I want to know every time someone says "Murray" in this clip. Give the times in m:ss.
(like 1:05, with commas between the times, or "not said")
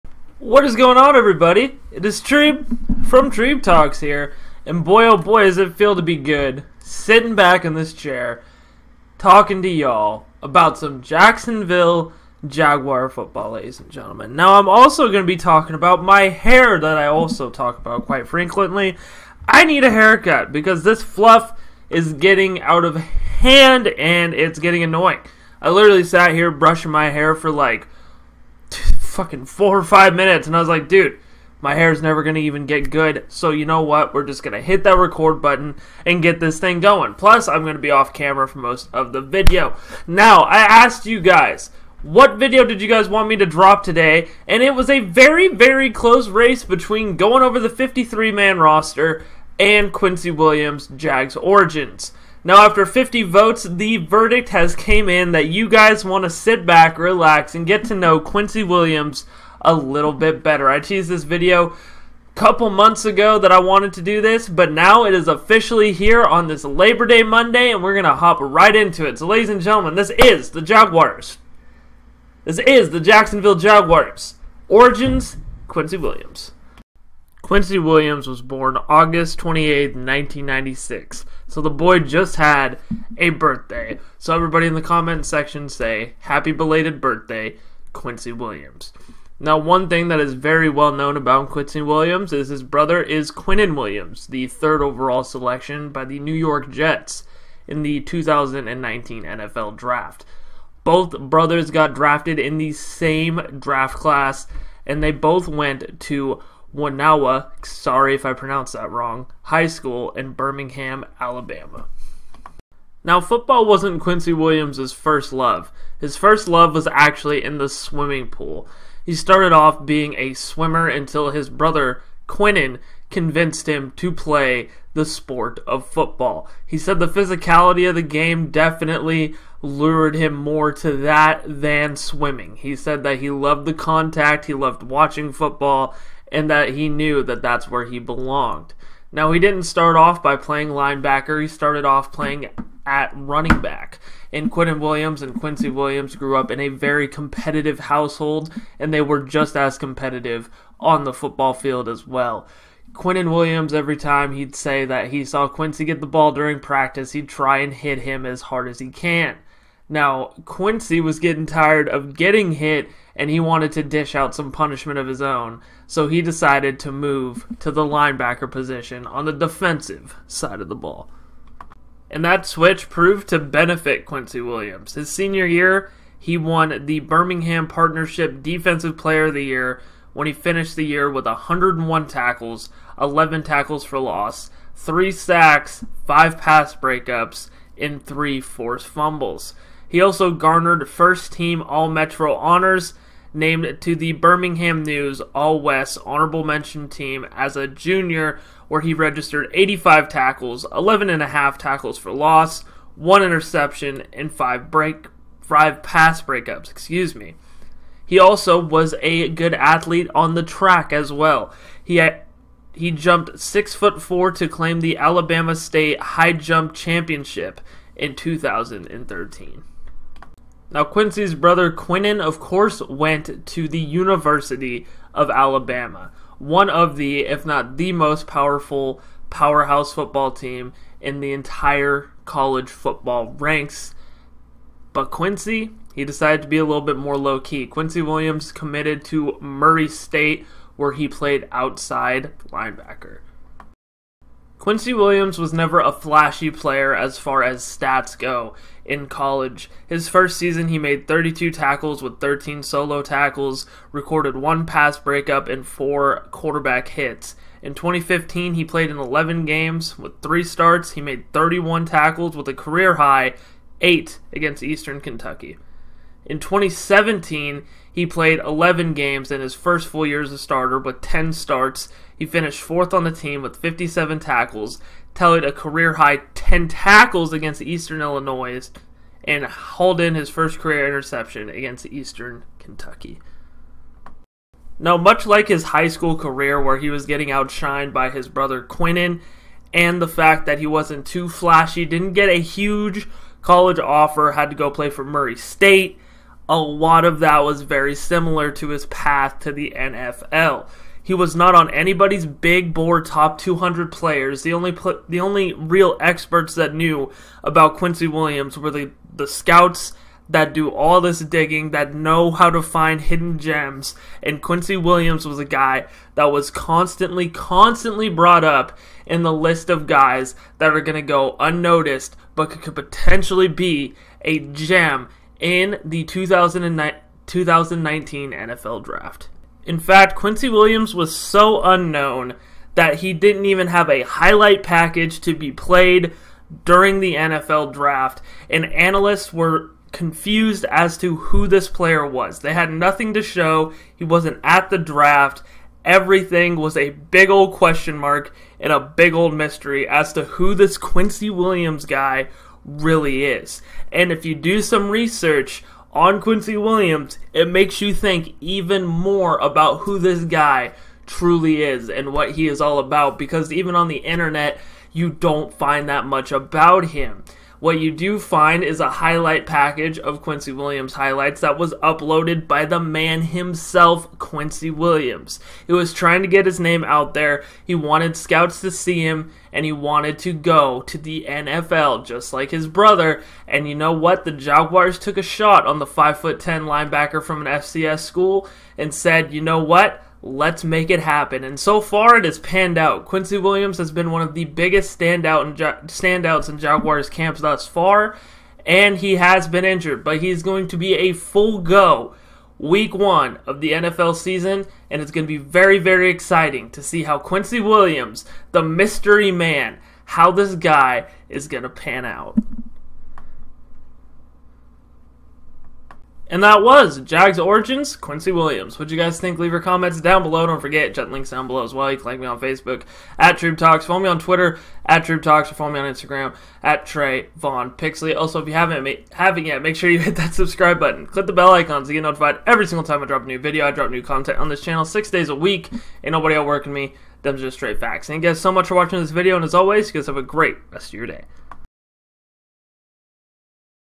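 3:59, 4:55.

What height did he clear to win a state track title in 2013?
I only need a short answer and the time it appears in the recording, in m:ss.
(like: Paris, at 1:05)
6 foot 4, at 3:33.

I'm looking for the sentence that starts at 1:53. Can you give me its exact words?
Now, football wasn't Quincy Williams' first love.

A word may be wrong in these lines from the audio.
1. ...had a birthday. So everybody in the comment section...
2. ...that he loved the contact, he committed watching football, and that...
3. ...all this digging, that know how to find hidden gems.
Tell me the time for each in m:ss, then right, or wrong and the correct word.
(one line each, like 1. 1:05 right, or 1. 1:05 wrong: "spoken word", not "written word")
1. 1:22 right
2. 2:13 wrong: "loved", not "committed"
3. 5:10 right.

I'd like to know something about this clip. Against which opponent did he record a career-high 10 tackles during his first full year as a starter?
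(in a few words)
Eastern Illinois.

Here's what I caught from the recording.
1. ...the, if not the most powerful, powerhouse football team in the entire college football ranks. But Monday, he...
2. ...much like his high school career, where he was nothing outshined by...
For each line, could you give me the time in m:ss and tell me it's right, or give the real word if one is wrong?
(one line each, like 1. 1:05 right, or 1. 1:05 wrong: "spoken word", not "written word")
1. 3:46 wrong: "Quincy", not "Monday"
2. 4:44 wrong: "getting", not "nothing".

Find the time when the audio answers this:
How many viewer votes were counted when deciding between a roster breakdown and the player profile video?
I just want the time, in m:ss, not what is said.
0:52.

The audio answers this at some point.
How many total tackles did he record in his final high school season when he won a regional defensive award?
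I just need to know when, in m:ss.
3:01.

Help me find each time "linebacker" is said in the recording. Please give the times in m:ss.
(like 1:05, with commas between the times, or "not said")
2:20, 2:47, 4:02, 6:26.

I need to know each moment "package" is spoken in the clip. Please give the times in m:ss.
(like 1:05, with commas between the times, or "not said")
5:34, 6:09.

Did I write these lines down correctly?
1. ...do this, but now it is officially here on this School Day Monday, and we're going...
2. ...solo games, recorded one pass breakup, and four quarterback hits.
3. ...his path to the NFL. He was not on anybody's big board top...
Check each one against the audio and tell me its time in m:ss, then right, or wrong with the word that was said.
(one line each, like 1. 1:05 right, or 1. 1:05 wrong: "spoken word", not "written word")
1. 1:04 wrong: "Labor", not "School"
2. 4:12 wrong: "tackles", not "games"
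3. 4:58 right.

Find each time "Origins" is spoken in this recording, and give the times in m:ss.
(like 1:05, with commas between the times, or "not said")
0:51, 1:14, 6:57.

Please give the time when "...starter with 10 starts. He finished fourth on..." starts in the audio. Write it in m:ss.
4:30.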